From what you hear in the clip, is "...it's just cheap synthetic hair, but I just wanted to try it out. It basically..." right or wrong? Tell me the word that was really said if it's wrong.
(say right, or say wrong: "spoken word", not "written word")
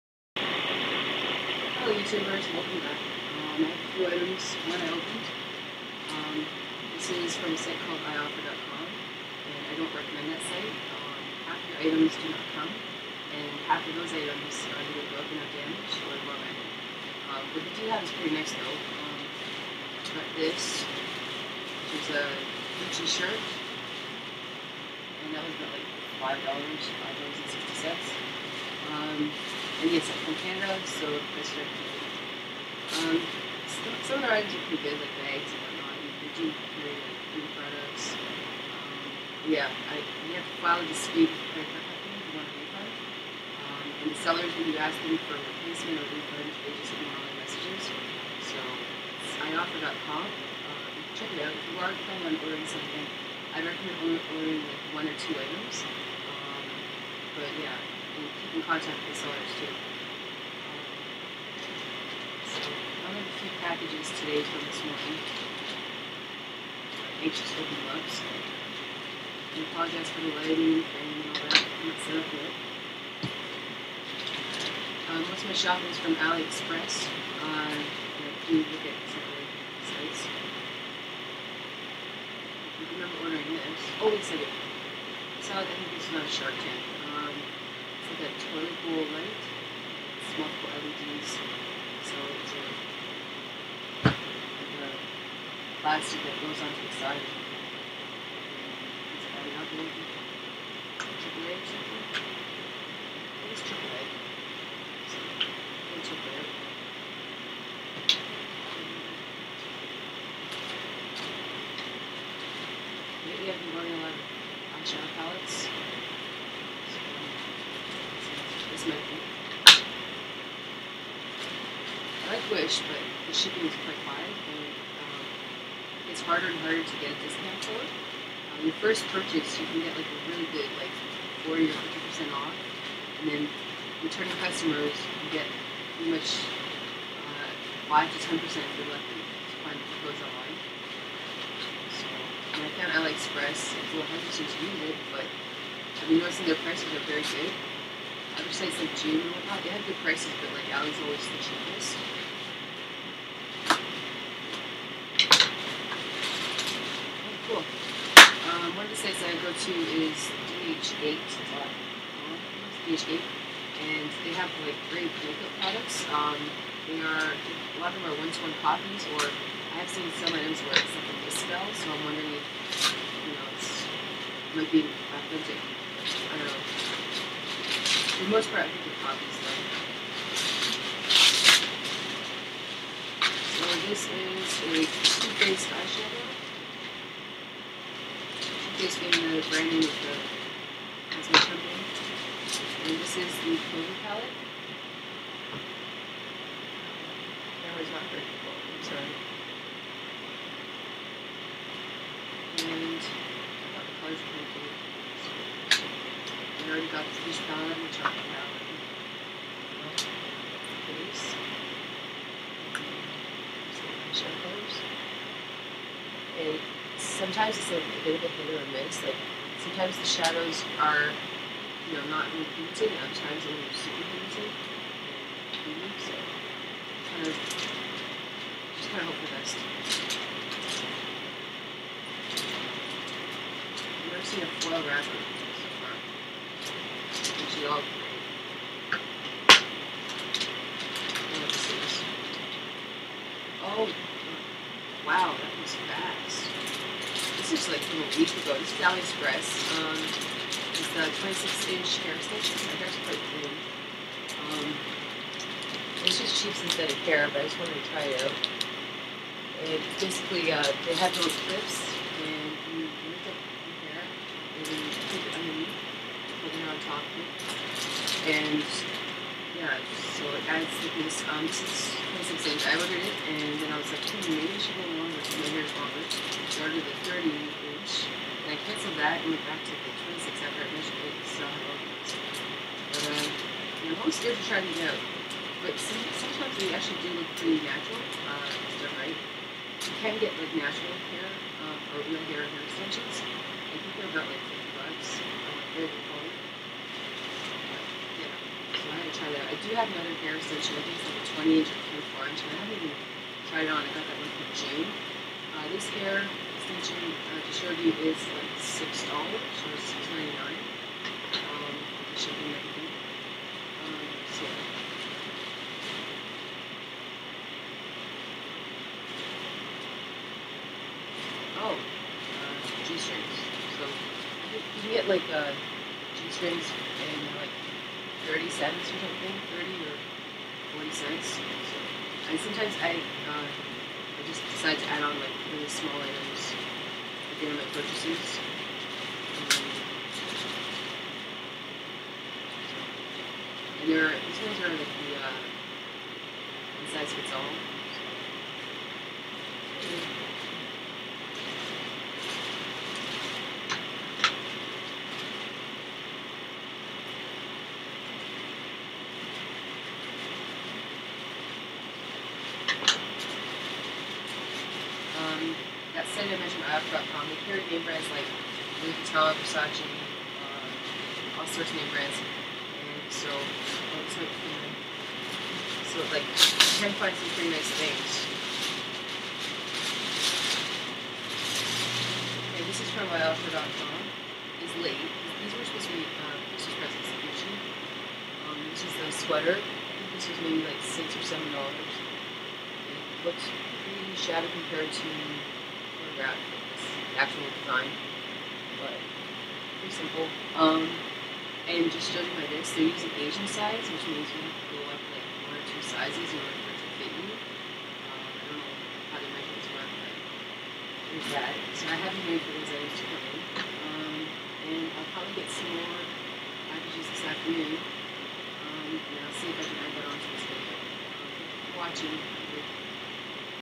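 right.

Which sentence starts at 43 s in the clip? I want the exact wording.
Um, and the sellers, when you ask them for a replacement or a refund, they just ignore all messages.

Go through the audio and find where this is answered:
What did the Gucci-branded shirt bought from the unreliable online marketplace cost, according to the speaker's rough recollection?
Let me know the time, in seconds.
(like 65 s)
26 s.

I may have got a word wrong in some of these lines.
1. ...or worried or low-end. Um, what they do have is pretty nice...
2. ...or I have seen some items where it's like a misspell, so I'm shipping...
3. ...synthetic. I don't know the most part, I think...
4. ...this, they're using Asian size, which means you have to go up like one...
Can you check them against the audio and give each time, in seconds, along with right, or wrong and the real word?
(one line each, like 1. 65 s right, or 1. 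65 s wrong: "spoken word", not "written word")
1. 15 s wrong: "damaged", not "worried"
2. 169 s wrong: "wondering", not "shipping"
3. 175 s wrong: "authentic", not "synthetic"
4. 402 s right.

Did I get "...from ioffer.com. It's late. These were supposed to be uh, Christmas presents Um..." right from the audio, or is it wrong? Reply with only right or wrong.
right.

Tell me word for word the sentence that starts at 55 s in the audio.
Um, but yeah and keep in contact with the sellers too.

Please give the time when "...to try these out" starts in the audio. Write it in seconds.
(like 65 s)
284 s.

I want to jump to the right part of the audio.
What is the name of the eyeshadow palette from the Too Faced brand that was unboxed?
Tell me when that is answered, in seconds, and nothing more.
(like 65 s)
193 s.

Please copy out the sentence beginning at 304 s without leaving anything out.
Uh, this hair extension uh, to you, is like six dollars or six ninety nine.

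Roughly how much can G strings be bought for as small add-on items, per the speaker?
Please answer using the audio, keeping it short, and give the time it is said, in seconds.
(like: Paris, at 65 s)
30 cents, at 328 s.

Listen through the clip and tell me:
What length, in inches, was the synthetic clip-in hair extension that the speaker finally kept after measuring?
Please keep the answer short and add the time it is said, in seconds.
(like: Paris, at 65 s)
26 inch, at 251 s.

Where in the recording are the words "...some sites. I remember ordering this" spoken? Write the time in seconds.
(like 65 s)
79 s.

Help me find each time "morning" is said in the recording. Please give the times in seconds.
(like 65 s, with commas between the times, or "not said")
64 s.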